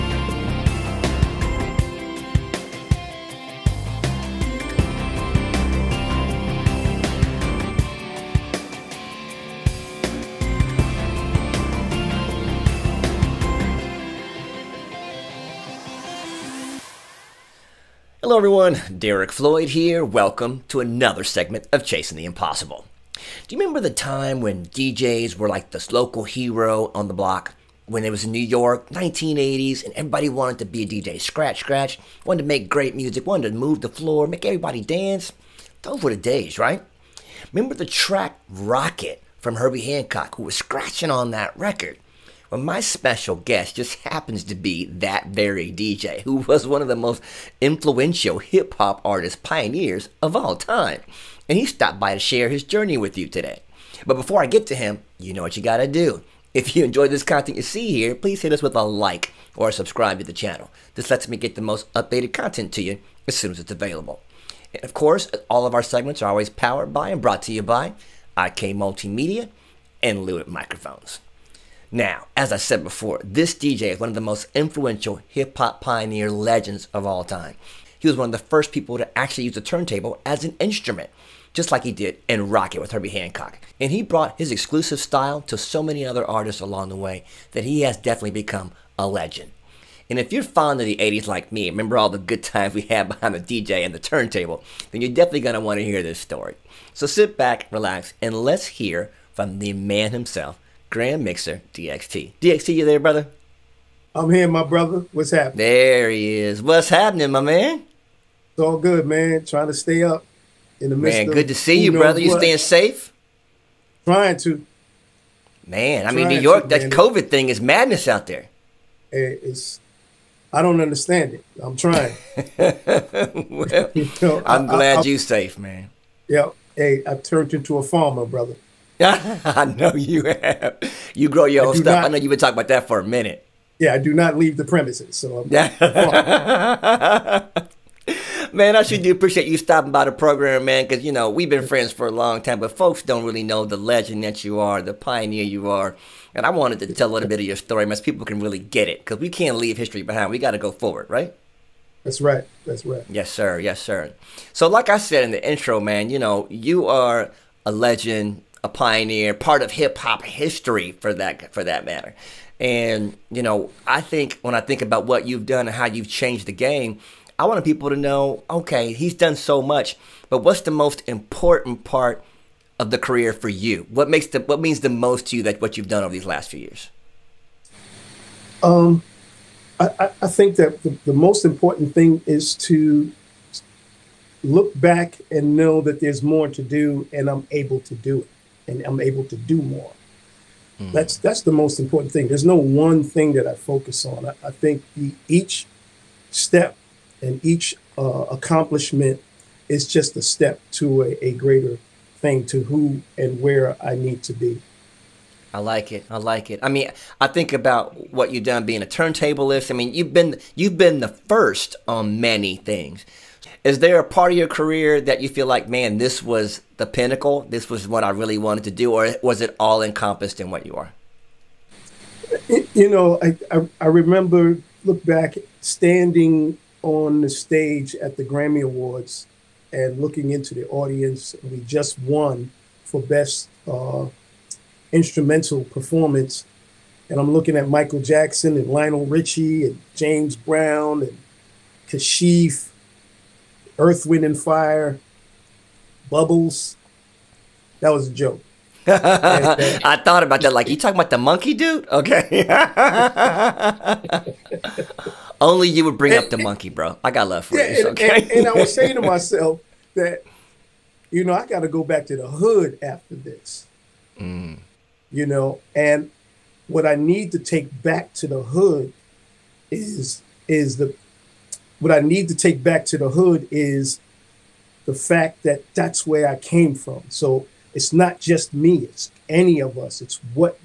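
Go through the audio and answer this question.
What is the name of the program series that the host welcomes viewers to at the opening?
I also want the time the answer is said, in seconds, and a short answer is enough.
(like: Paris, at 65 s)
Chasing the Impossible, at 21 s.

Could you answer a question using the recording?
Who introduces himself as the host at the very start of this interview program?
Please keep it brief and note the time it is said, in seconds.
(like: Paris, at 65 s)
Derrick Floyd, at 18 s.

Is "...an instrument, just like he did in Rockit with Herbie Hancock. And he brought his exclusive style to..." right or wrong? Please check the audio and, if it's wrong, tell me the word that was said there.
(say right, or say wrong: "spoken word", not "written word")
right.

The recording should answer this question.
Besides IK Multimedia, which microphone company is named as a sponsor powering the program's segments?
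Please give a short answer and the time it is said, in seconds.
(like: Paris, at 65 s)
Lewitt Microphones, at 70 s.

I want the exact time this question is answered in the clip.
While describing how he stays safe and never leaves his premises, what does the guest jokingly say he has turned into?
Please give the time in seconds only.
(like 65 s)
127 s.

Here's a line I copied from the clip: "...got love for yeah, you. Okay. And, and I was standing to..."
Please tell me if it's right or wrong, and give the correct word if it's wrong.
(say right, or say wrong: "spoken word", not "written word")
wrong: "saying", not "standing".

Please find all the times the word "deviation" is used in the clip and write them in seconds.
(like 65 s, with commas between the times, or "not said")
not said.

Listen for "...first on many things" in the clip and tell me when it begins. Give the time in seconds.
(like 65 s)
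211 s.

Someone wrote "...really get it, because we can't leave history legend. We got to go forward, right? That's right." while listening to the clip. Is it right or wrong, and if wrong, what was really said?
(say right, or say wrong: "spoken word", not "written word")
wrong: "behind", not "legend".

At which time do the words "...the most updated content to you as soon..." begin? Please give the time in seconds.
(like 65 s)
61 s.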